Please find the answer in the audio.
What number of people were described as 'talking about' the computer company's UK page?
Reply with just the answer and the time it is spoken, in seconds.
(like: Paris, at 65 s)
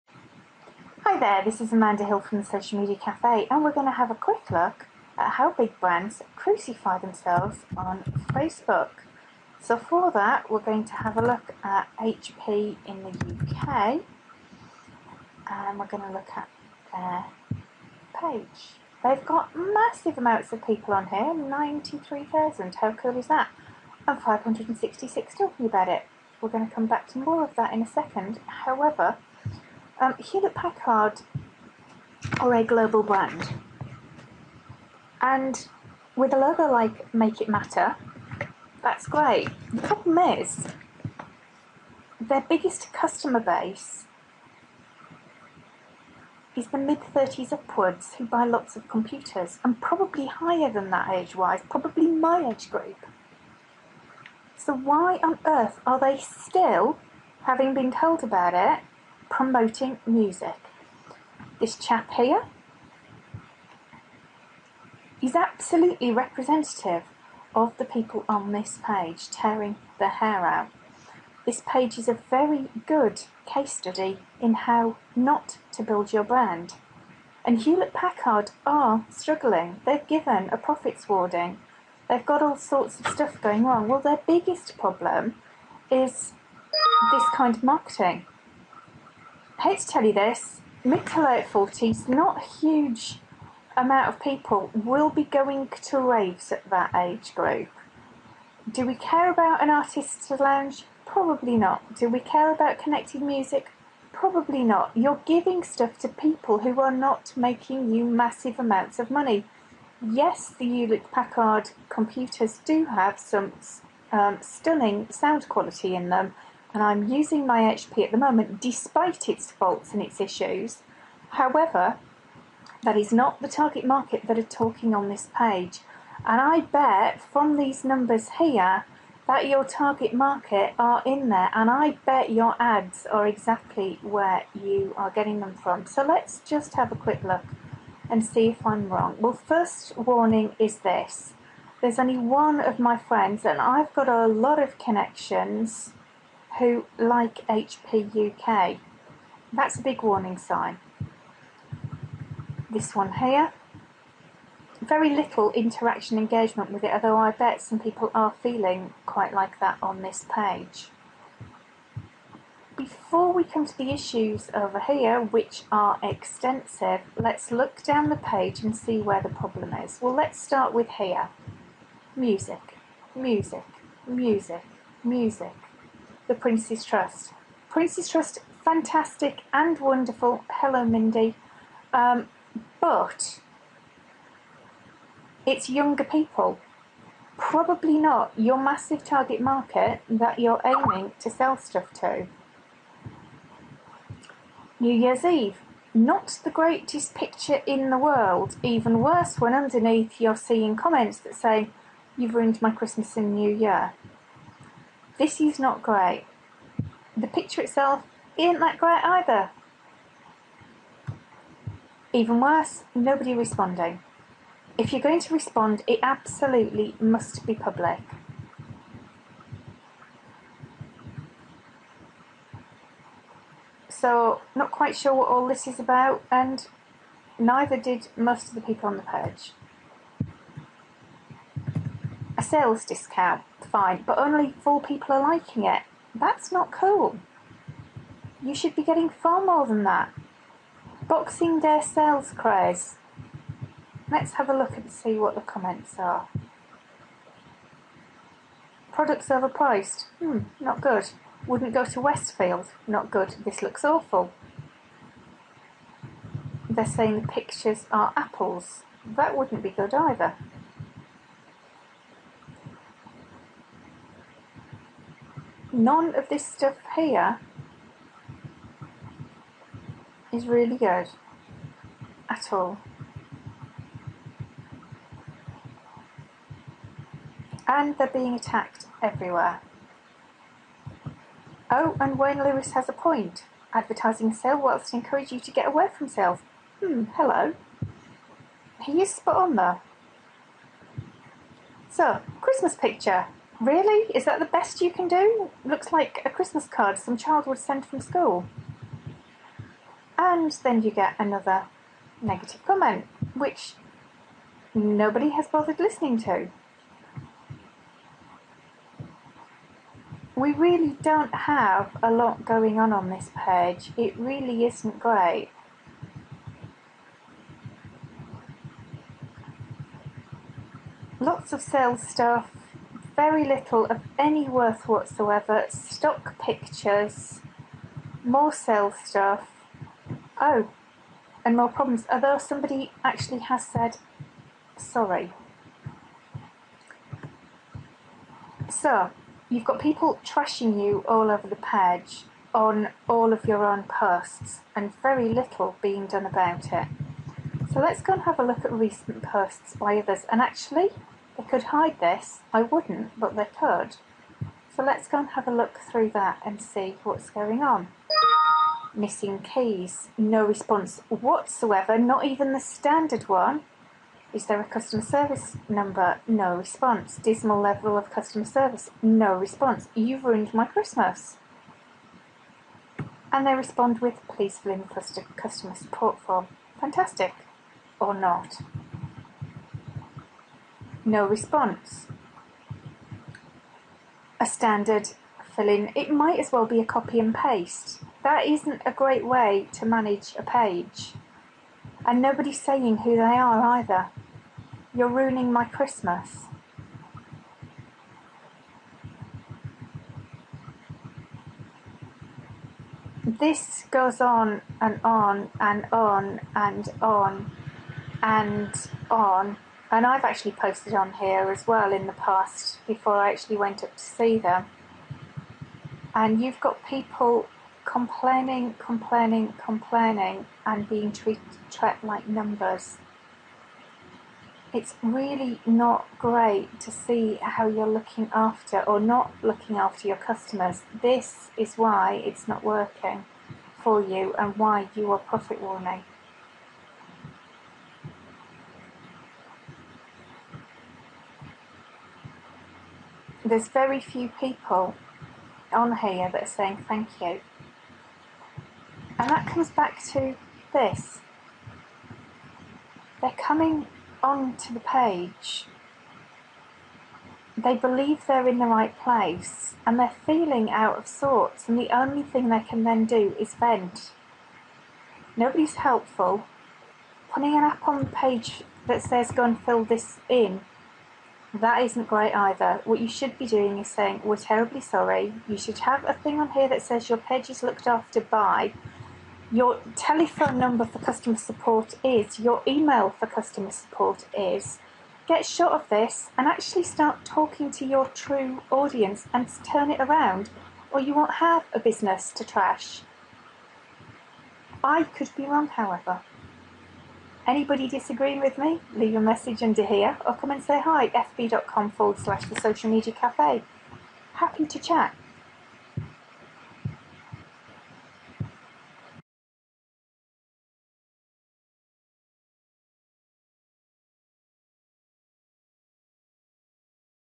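566, at 24 s.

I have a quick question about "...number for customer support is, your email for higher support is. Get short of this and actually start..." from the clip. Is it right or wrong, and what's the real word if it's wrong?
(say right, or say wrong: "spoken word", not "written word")
wrong: "customer", not "higher".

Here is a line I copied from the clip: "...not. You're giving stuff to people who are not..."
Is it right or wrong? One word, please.
right.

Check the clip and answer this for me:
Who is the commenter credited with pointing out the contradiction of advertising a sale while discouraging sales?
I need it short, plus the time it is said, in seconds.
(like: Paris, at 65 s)
Wayne Lewis, at 282 s.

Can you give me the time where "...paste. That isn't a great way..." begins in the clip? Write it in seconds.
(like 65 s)
387 s.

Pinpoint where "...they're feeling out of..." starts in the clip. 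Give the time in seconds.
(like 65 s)
459 s.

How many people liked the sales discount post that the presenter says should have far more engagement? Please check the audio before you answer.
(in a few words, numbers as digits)
four.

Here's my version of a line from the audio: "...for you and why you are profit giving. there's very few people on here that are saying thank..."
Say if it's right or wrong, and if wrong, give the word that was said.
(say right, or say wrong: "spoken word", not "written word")
wrong: "warning", not "giving".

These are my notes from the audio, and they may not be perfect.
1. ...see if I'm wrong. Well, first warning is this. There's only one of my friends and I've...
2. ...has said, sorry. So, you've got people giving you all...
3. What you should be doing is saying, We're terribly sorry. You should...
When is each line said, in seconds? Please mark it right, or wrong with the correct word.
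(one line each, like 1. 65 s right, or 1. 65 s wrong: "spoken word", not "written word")
1. 138 s right
2. 333 s wrong: "trashing", not "giving"
3. 472 s right.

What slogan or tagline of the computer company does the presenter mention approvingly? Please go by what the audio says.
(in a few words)
Make It Matter.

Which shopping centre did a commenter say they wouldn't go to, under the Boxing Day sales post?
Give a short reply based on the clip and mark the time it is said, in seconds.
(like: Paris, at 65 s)
Westfield, at 252 s.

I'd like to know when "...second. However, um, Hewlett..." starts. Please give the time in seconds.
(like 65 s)
27 s.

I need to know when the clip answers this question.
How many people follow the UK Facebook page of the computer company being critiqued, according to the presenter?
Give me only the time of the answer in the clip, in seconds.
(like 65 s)
21 s.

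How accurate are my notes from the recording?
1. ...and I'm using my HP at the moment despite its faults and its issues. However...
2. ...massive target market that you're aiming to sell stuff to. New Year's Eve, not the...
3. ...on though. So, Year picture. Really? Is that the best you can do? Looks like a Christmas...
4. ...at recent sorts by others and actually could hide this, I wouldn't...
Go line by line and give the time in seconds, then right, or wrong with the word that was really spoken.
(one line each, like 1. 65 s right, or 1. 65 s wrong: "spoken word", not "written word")
1. 116 s right
2. 188 s right
3. 289 s wrong: "Christmas", not "Year"
4. 348 s wrong: "posts", not "sorts".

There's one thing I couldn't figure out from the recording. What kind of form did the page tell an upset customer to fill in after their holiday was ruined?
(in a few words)
customer support form.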